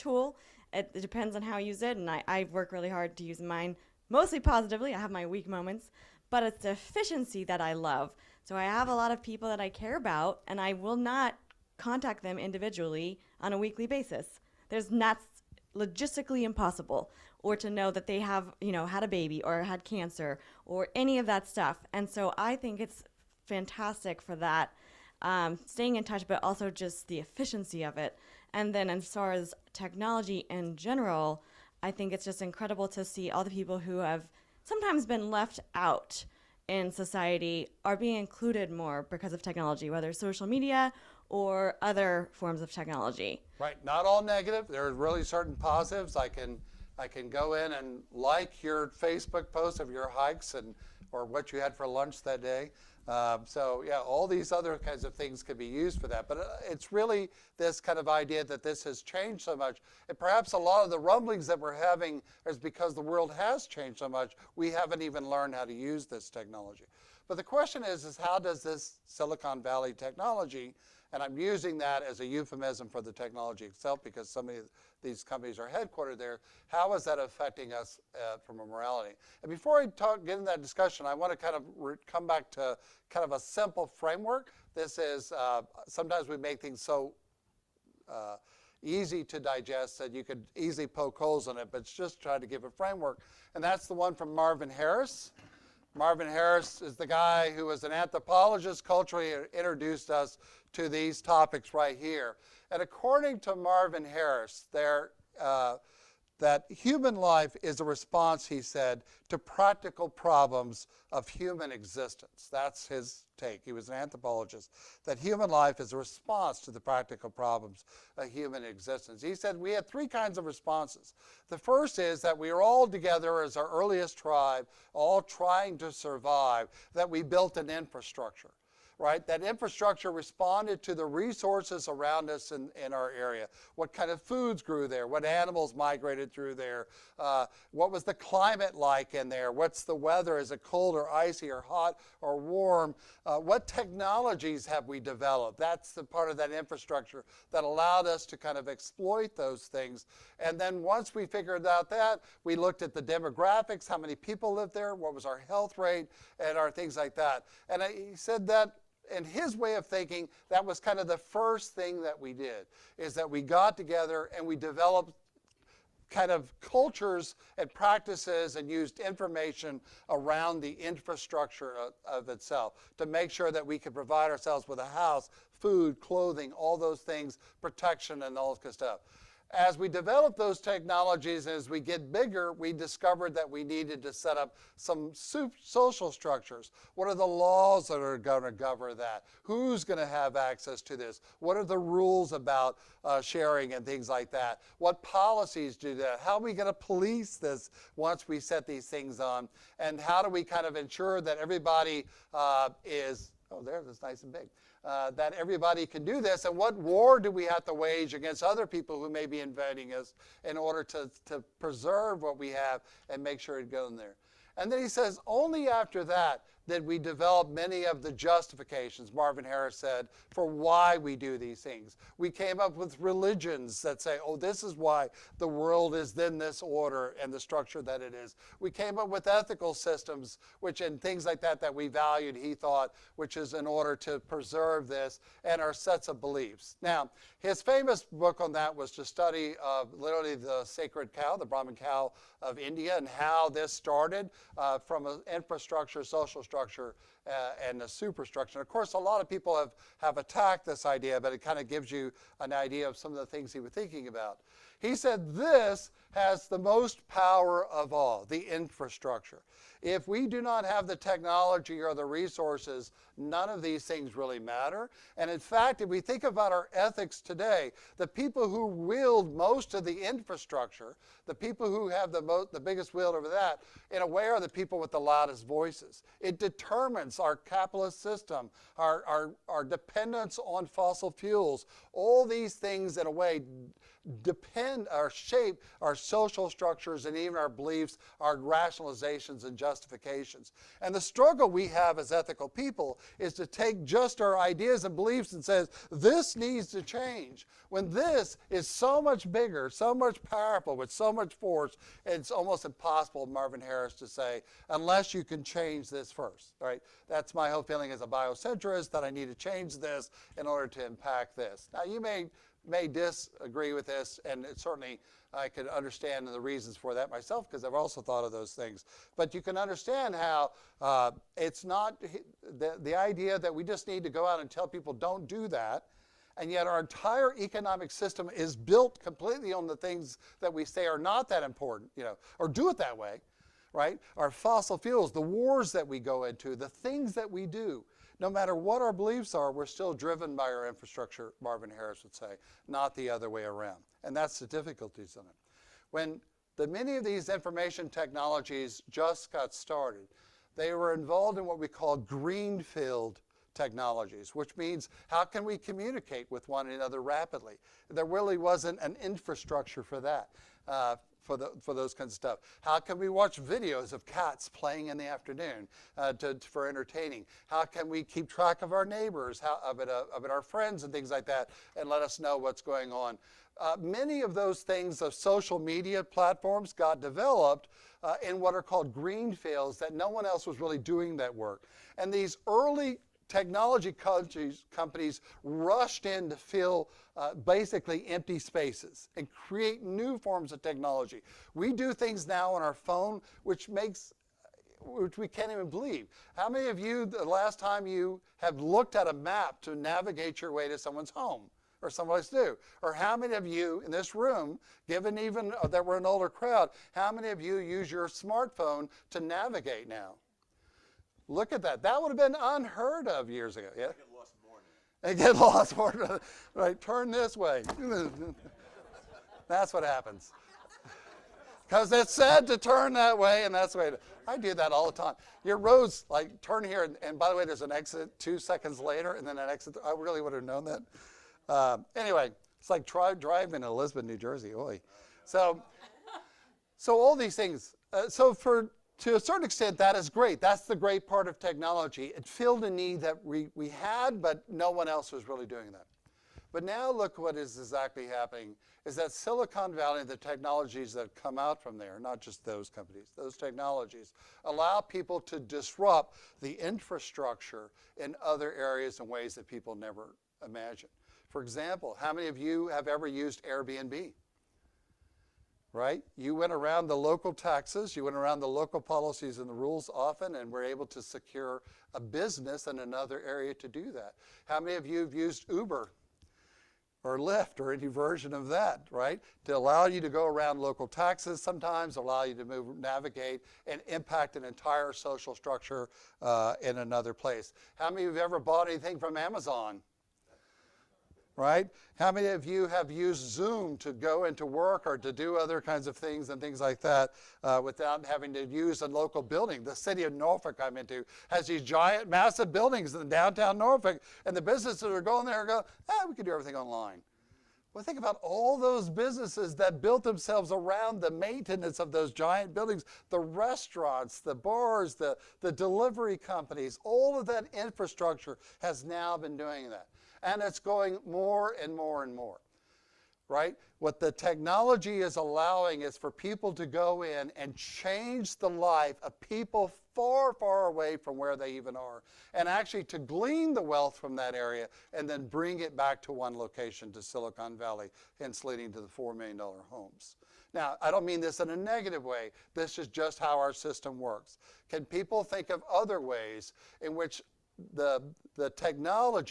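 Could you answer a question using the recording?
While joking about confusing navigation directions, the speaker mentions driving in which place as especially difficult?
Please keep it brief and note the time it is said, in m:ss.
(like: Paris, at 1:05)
Lisbon, New Jersey, at 7:13.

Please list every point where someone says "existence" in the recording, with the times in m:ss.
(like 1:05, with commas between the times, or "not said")
1:51, 1:58.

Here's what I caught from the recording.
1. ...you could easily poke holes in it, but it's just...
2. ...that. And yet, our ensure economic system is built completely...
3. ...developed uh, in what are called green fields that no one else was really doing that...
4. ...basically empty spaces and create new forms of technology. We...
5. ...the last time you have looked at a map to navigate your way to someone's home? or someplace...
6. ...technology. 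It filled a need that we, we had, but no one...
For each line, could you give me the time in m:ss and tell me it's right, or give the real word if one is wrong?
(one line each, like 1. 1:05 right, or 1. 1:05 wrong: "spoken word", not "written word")
1. 1:30 right
2. 5:25 wrong: "entire", not "ensure"
3. 6:17 right
4. 6:27 right
5. 6:37 right
6. 7:21 right.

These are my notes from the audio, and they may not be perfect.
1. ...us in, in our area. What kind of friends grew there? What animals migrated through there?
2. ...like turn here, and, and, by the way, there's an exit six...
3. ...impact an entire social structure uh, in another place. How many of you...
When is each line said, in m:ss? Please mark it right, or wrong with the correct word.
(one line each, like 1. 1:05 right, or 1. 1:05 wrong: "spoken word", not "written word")
1. 2:12 wrong: "foods", not "friends"
2. 7:06 wrong: "two", not "six"
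3. 8:03 right.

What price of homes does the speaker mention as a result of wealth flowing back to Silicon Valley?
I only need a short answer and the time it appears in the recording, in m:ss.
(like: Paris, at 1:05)
$4 million, at 8:58.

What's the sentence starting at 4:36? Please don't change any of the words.
It determines our capitalist system, our, our, our dependence on fossil fuels.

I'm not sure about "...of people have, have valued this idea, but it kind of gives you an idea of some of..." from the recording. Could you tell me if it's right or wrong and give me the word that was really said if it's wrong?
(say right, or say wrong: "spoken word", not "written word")
wrong: "attacked", not "valued".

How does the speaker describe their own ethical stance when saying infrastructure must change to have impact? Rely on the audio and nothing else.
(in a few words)
biocentrist.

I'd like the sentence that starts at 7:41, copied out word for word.
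For example, how many of you have ever used Airbnb?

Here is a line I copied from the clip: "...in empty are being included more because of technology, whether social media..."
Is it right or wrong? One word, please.
wrong.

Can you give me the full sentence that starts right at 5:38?
No matter what our beliefs are, we're still driven by our infrastructure, Marvin Harris would say, not the other way around.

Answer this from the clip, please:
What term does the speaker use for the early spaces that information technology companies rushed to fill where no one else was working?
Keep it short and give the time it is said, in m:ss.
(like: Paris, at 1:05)
greenfield technologies, at 5:51.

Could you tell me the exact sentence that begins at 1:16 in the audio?
How is that affecting us uh, from a morality?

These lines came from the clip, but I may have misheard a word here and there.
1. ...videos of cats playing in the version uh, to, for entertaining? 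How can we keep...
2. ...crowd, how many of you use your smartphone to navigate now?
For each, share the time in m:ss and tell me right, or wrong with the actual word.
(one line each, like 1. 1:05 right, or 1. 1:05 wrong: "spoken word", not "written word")
1. 6:03 wrong: "afternoon", not "version"
2. 6:46 right.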